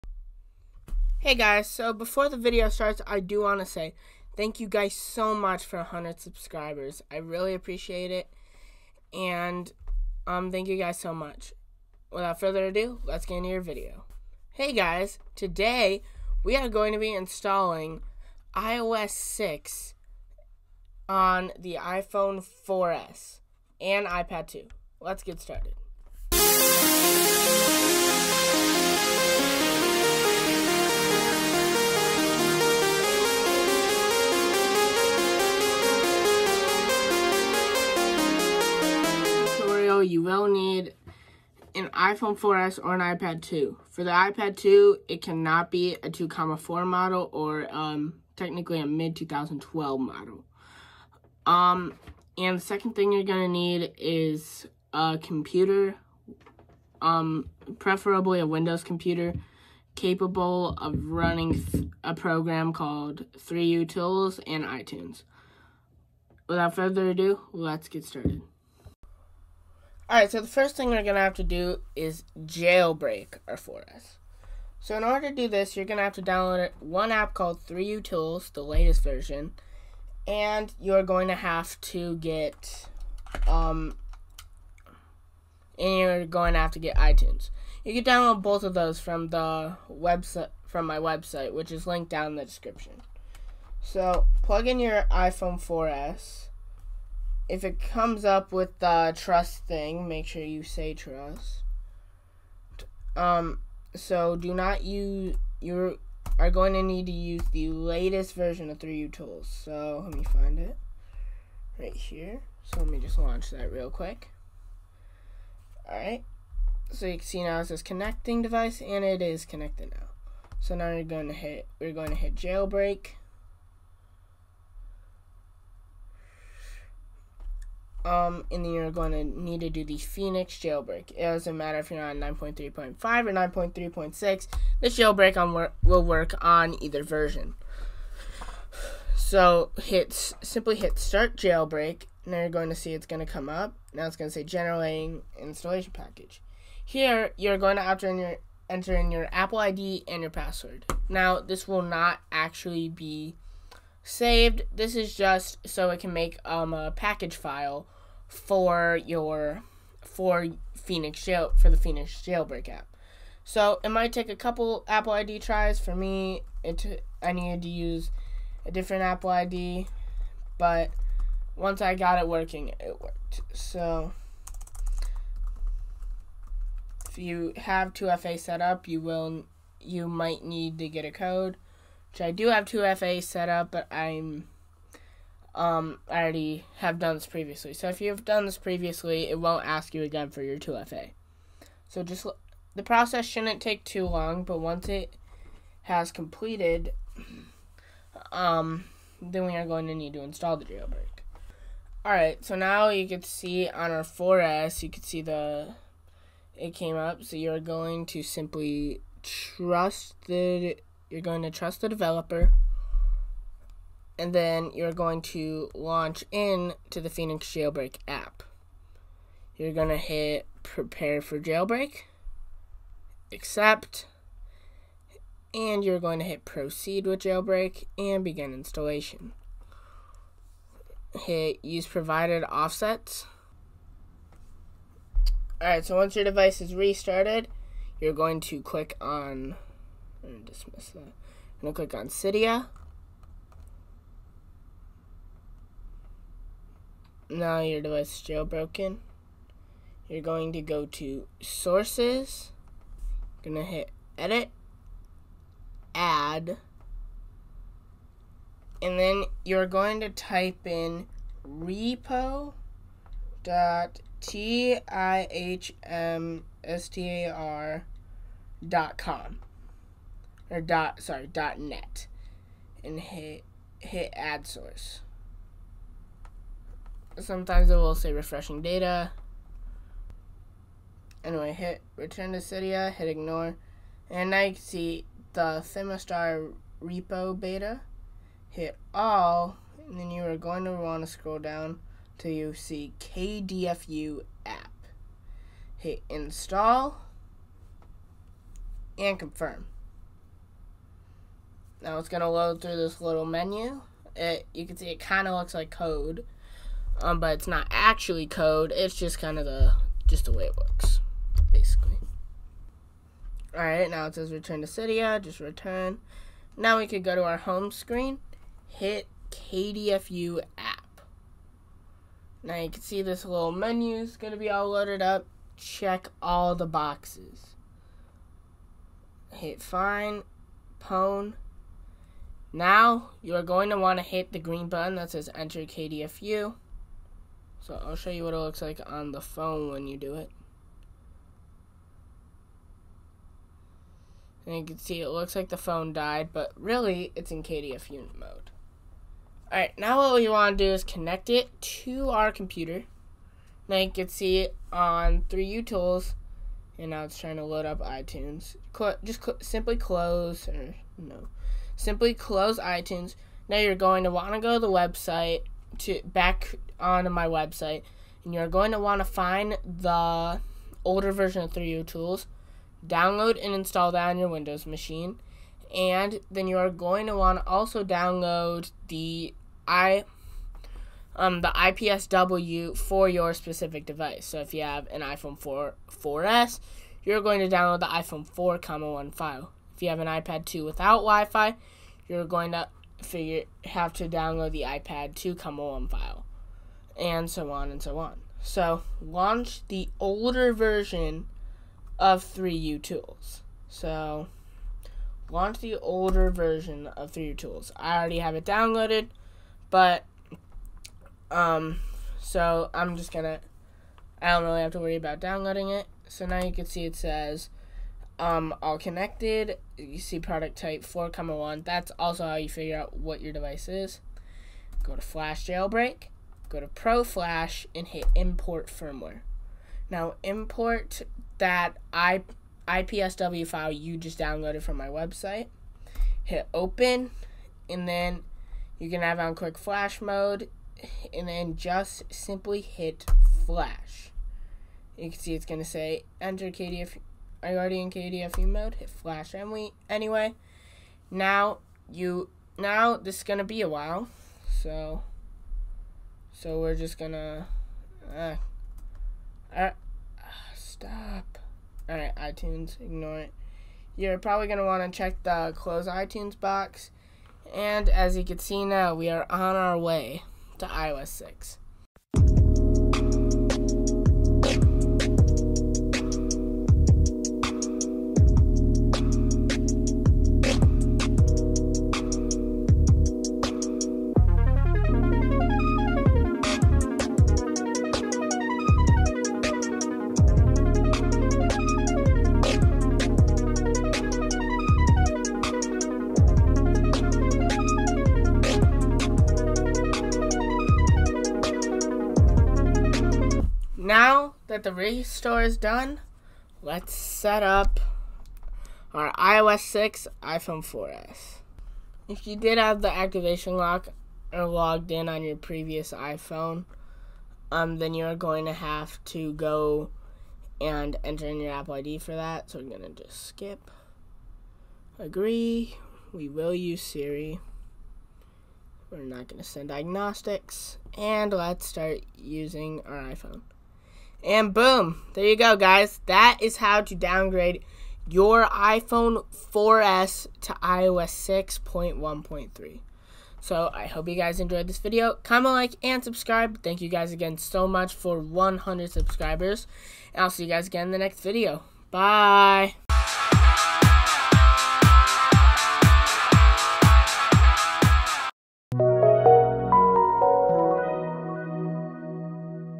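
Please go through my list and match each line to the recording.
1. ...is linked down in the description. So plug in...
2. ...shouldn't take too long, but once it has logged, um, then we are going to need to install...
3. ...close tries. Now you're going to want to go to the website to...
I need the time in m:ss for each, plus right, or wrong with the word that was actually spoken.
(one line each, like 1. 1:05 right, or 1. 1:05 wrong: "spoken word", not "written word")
1. 1:31 right
2. 3:13 wrong: "completed", not "logged"
3. 6:02 wrong: "iTunes", not "tries".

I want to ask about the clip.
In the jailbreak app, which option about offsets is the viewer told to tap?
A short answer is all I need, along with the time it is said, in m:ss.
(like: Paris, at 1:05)
use provided offsets, at 3:51.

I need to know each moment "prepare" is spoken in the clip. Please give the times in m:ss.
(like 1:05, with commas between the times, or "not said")
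3:40.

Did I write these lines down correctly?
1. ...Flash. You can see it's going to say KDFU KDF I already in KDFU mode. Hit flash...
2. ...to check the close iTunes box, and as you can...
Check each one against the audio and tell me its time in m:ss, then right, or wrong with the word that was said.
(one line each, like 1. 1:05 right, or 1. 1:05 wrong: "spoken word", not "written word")
1. 7:23 wrong: "Enter", not "KDFU"
2. 7:44 right.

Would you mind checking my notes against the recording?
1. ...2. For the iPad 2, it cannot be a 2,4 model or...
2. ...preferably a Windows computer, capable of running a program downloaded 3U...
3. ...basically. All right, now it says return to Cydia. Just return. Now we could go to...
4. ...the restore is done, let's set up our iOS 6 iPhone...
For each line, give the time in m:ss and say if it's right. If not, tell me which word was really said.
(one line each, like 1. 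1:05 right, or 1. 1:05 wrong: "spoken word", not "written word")
1. 0:43 right
2. 0:57 wrong: "called", not "downloaded"
3. 5:11 right
4. 8:24 right.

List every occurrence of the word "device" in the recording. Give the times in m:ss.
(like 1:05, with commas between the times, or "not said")
1:58, 3:56, 4:07, 6:23, 7:03.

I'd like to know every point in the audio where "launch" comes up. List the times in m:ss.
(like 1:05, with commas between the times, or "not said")
1:53, 3:35, 6:39, 6:45.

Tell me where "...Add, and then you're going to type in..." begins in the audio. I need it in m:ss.
4:15.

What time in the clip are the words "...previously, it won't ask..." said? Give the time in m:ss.
3:08.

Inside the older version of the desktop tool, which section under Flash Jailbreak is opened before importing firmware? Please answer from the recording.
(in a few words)
Pro Flash.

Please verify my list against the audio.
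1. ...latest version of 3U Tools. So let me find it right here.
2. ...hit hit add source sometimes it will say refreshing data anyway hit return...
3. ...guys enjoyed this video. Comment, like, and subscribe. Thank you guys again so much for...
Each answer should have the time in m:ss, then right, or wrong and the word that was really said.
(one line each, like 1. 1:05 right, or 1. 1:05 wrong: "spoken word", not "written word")
1. 1:47 right
2. 4:32 right
3. 9:04 right.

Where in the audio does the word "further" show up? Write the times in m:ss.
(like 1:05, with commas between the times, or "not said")
0:12, 1:06.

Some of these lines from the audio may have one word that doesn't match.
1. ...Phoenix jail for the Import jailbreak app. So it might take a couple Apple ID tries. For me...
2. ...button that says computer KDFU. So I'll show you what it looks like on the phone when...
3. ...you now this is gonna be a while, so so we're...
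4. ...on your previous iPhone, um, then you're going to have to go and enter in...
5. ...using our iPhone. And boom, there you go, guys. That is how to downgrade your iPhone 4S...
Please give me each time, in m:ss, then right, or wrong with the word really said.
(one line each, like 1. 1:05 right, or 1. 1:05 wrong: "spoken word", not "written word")
1. 2:40 wrong: "Phoenix", not "Import"
2. 5:34 wrong: "enter", not "computer"
3. 7:31 right
4. 8:35 right
5. 8:52 right.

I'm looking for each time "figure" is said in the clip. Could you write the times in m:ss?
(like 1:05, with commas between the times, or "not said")
6:33, 7:02.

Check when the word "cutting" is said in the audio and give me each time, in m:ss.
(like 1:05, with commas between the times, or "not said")
not said.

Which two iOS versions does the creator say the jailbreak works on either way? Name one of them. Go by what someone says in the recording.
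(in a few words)
9.3.5.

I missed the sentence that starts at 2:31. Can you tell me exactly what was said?
Now this will not actually be saved.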